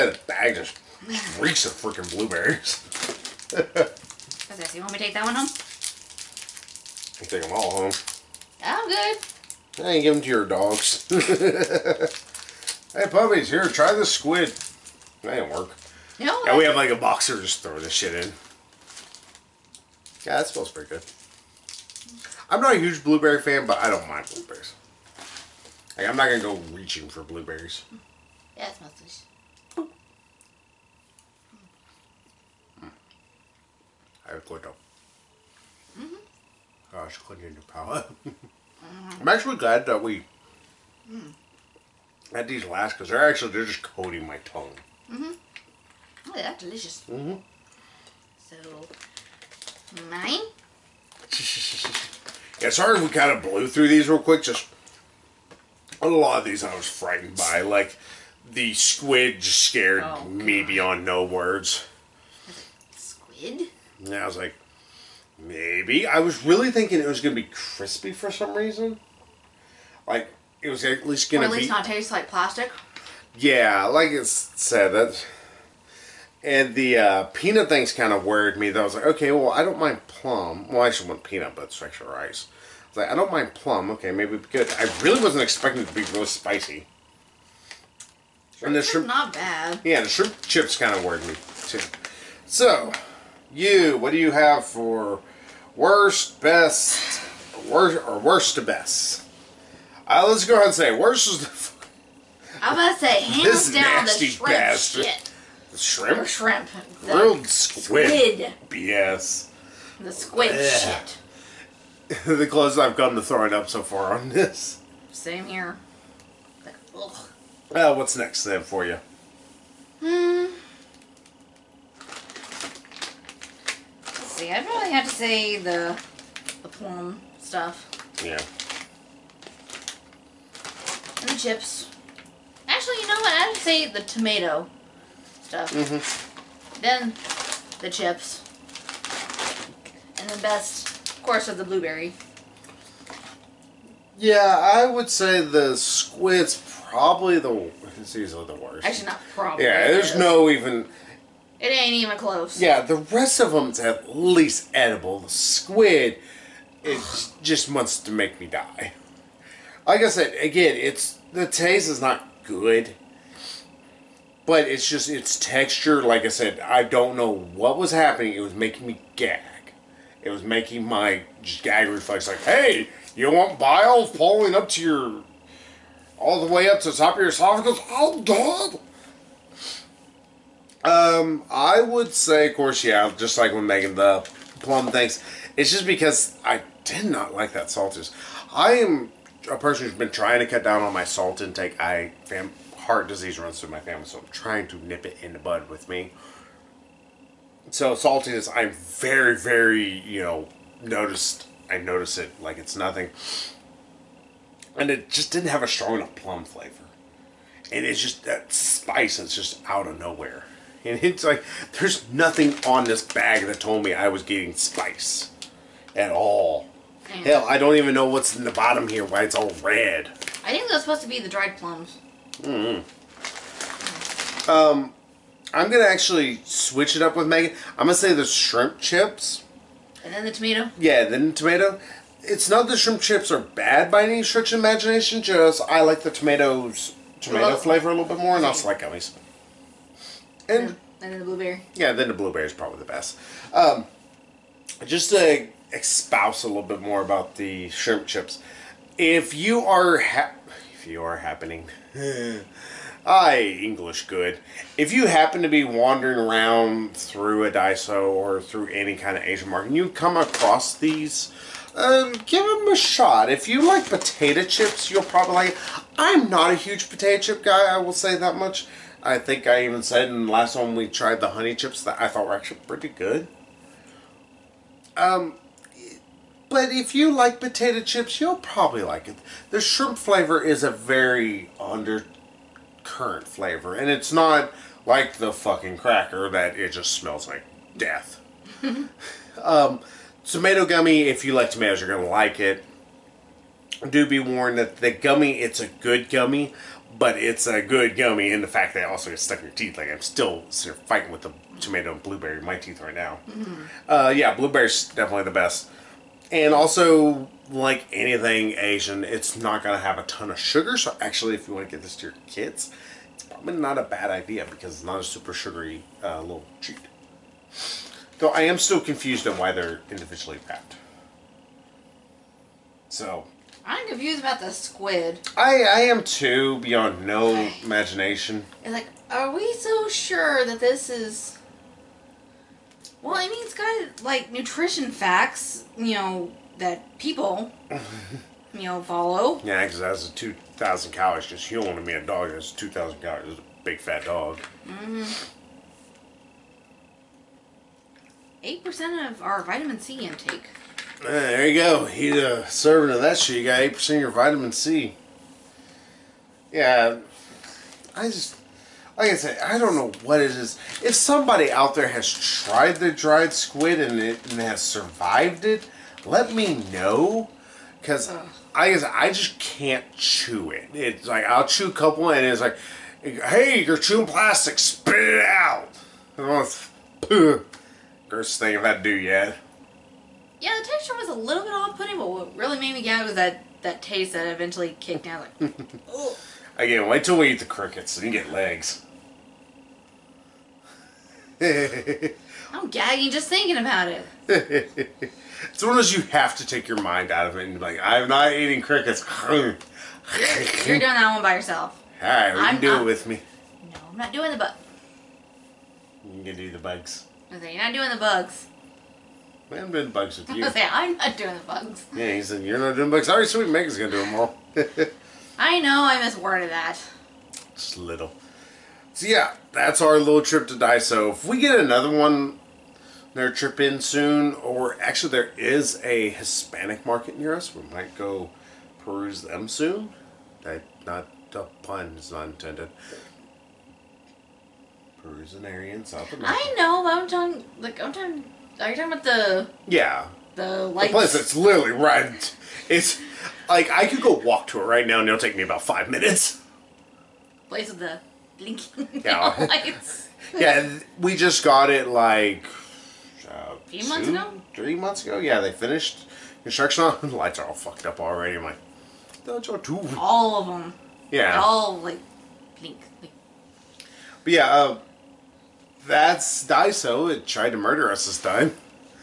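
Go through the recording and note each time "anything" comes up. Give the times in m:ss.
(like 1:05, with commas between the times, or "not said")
5:07.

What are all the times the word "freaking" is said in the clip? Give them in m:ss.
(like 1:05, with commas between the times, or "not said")
0:01.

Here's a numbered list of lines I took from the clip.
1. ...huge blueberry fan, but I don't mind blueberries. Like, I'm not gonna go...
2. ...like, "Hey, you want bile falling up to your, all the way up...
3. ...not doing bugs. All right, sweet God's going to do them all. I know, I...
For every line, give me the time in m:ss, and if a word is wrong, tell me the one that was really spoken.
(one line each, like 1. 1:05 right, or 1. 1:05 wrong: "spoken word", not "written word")
1. 0:22 right
2. 2:52 right
3. 6:52 wrong: "Meg", not "God".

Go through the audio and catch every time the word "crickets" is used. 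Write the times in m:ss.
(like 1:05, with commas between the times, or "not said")
6:27, 6:38.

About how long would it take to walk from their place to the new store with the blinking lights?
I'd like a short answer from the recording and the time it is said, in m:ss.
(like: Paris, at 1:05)
5 minutes, at 7:25.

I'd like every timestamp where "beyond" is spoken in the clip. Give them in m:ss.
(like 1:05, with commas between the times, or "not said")
1:00, 5:26.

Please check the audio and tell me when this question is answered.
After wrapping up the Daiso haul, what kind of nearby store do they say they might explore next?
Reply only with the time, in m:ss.
7:06.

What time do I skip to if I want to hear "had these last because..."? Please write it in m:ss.
0:42.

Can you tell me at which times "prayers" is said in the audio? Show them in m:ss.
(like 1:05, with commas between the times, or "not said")
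not said.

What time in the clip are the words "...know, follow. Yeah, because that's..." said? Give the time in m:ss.
5:38.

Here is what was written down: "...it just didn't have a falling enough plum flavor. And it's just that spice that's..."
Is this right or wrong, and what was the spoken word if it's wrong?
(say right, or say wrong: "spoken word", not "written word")
wrong: "strong", not "falling".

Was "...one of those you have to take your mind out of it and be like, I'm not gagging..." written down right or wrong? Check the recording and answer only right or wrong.
wrong.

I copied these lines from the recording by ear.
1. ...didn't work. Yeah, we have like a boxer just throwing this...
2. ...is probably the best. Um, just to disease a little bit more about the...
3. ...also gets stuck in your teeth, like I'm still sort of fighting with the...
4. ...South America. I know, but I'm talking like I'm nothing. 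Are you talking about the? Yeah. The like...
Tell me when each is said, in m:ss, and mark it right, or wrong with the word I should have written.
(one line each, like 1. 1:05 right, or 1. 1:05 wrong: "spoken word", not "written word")
1. 0:15 right
2. 4:02 wrong: "expouse", not "disease"
3. 4:58 right
4. 7:15 wrong: "talking", not "nothing".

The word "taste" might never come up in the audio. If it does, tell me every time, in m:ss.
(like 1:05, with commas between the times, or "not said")
1:11, 2:41, 6:23.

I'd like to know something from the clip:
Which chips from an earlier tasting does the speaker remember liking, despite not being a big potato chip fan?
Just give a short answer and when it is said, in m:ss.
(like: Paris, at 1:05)
honey chips, at 4:31.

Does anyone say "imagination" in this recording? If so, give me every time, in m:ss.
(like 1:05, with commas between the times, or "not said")
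3:54, 5:27.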